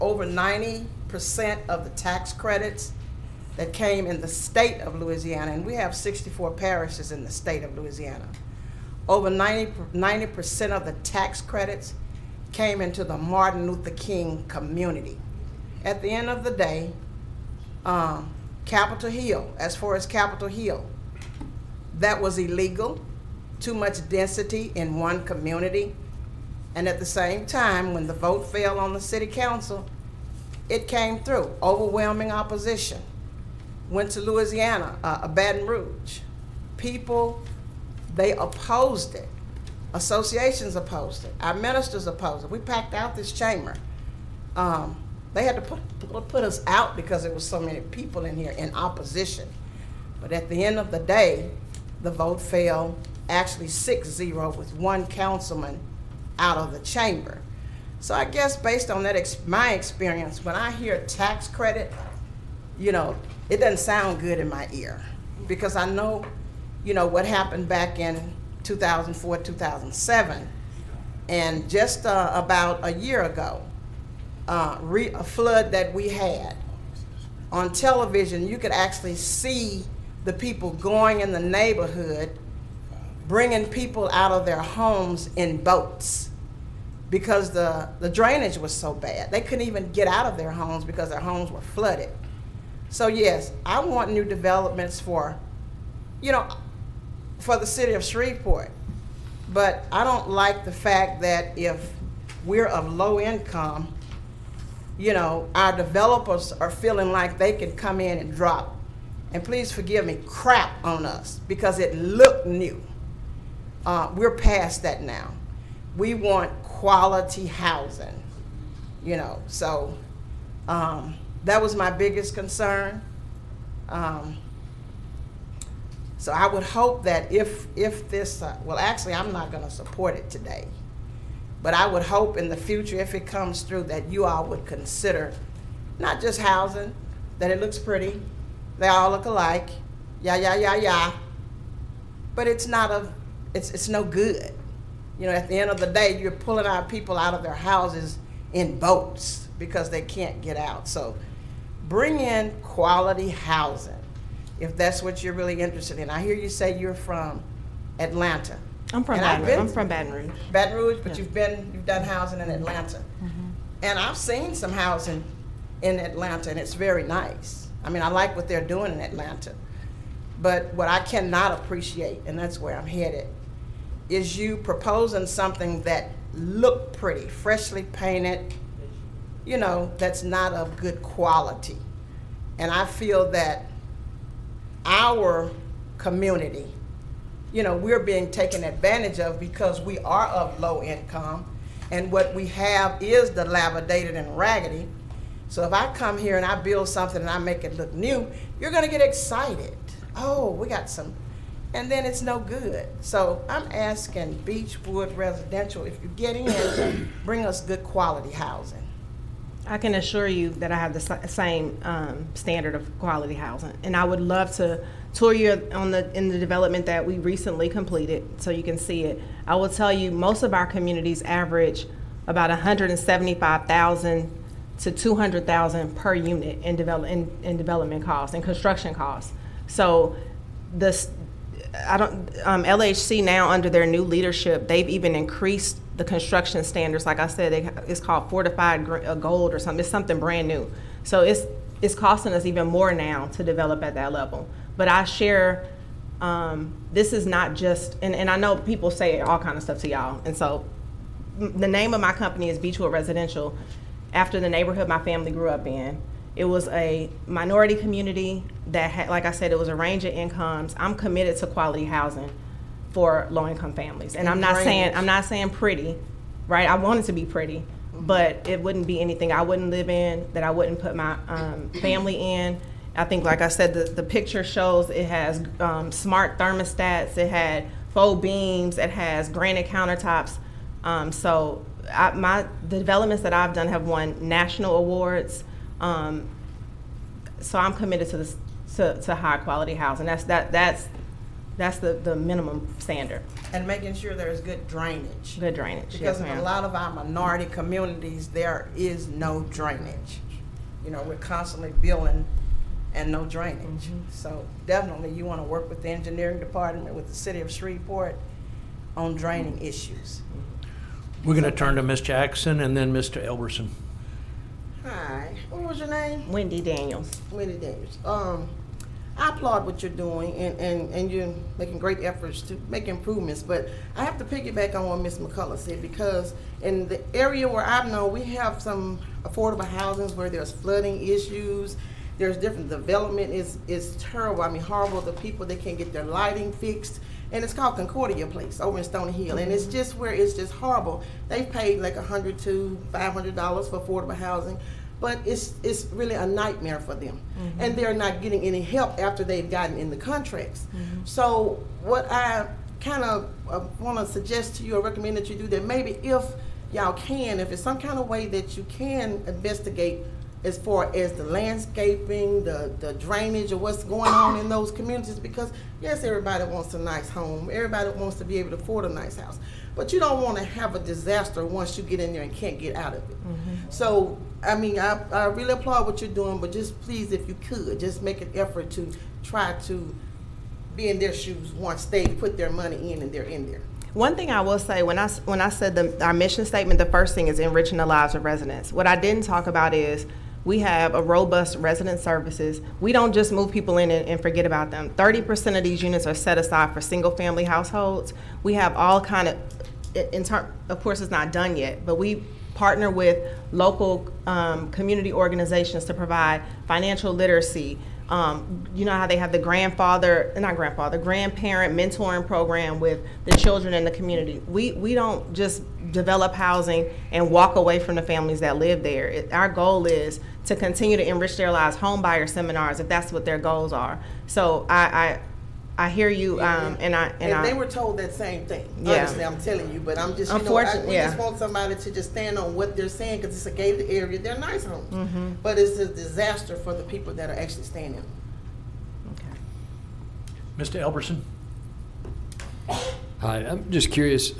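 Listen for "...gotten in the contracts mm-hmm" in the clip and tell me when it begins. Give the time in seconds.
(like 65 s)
349 s.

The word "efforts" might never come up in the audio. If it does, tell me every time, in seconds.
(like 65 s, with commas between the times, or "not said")
322 s, 378 s.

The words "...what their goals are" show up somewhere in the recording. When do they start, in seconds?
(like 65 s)
423 s.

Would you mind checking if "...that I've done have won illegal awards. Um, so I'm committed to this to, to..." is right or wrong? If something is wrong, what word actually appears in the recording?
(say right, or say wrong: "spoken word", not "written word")
wrong: "national", not "illegal".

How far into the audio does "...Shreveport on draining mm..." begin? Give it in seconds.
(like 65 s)
307 s.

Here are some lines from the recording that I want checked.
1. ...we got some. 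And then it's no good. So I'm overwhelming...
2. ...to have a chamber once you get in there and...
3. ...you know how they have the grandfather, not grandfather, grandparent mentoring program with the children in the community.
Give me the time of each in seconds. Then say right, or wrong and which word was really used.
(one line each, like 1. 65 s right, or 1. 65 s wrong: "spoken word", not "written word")
1. 200 s wrong: "asking", not "overwhelming"
2. 370 s wrong: "disaster", not "chamber"
3. 408 s right.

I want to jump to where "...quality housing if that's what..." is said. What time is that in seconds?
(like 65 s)
152 s.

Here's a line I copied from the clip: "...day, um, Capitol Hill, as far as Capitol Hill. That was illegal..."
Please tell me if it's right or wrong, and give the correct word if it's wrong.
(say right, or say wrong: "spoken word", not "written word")
right.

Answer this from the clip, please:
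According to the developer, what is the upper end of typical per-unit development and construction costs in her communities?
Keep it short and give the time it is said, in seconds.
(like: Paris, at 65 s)
200,000, at 224 s.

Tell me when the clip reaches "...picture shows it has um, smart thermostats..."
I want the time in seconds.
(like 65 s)
274 s.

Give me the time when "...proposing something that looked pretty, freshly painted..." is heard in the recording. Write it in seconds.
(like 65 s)
174 s.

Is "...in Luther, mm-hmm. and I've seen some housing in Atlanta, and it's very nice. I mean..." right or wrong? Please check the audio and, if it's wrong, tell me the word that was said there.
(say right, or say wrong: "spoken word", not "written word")
wrong: "Atlanta", not "Luther".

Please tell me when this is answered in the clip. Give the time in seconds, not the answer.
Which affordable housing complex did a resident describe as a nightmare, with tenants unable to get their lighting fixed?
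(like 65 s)
337 s.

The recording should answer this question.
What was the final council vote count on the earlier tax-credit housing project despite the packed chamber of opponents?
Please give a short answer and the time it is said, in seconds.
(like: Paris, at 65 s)
6-0, at 53 s.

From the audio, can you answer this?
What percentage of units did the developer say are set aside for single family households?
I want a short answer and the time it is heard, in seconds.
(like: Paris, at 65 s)
30%, at 394 s.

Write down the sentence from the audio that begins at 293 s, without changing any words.
And making sure there's good drainage.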